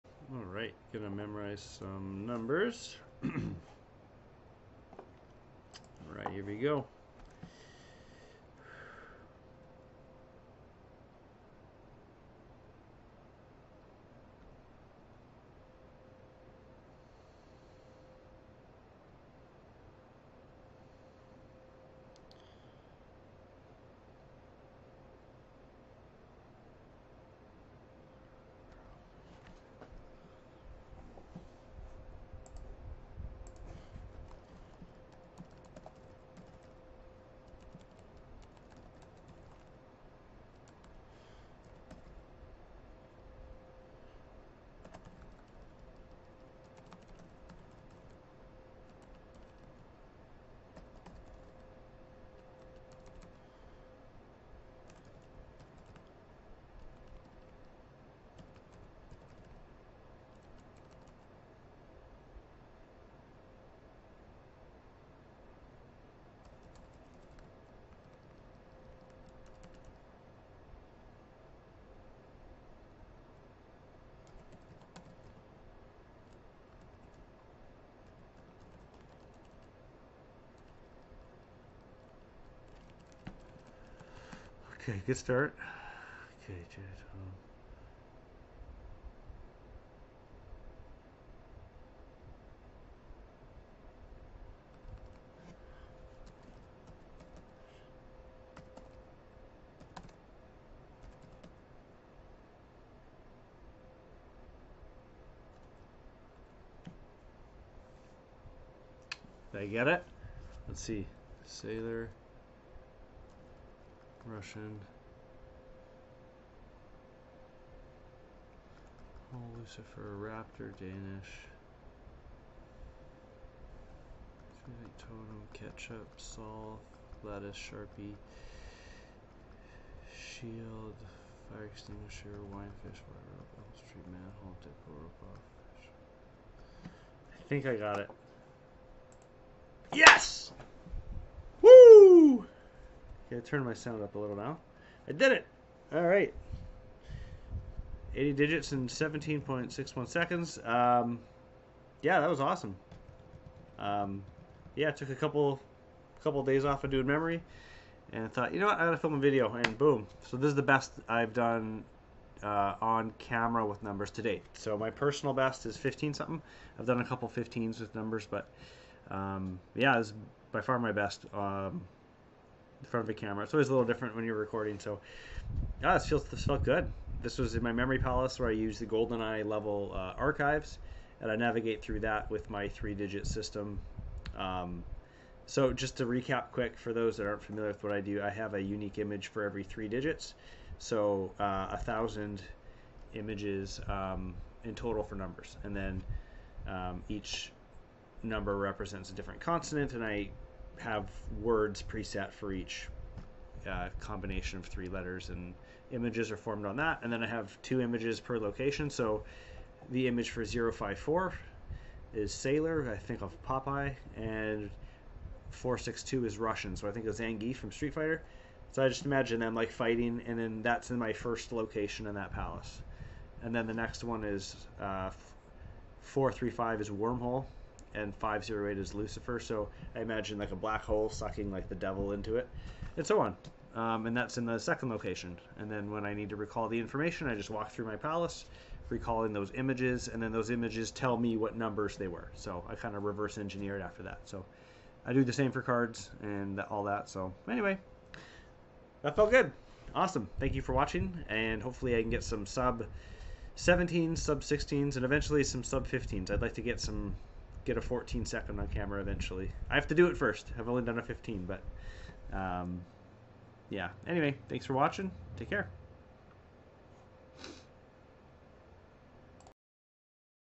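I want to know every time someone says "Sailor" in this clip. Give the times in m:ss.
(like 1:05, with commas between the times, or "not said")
1:51, 3:32.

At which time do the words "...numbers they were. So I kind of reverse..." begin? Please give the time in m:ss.
4:01.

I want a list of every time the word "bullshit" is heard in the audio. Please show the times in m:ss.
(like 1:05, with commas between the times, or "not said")
not said.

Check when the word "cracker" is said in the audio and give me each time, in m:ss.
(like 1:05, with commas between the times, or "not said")
not said.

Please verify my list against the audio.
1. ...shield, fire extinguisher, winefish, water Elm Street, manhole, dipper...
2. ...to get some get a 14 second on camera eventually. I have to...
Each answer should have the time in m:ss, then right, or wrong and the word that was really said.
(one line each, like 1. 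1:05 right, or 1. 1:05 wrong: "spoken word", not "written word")
1. 2:10 right
2. 4:16 right.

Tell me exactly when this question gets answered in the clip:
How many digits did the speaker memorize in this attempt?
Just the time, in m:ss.
2:28.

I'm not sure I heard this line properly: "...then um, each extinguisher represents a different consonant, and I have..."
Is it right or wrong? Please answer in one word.
wrong.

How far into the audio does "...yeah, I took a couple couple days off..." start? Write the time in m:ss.
2:34.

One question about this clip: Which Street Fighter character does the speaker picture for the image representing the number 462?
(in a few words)
Zangief.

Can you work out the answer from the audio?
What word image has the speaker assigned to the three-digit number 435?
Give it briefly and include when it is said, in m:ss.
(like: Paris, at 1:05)
Wormhole, at 3:46.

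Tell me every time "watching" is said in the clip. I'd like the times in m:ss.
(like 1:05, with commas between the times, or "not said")
4:10, 4:24.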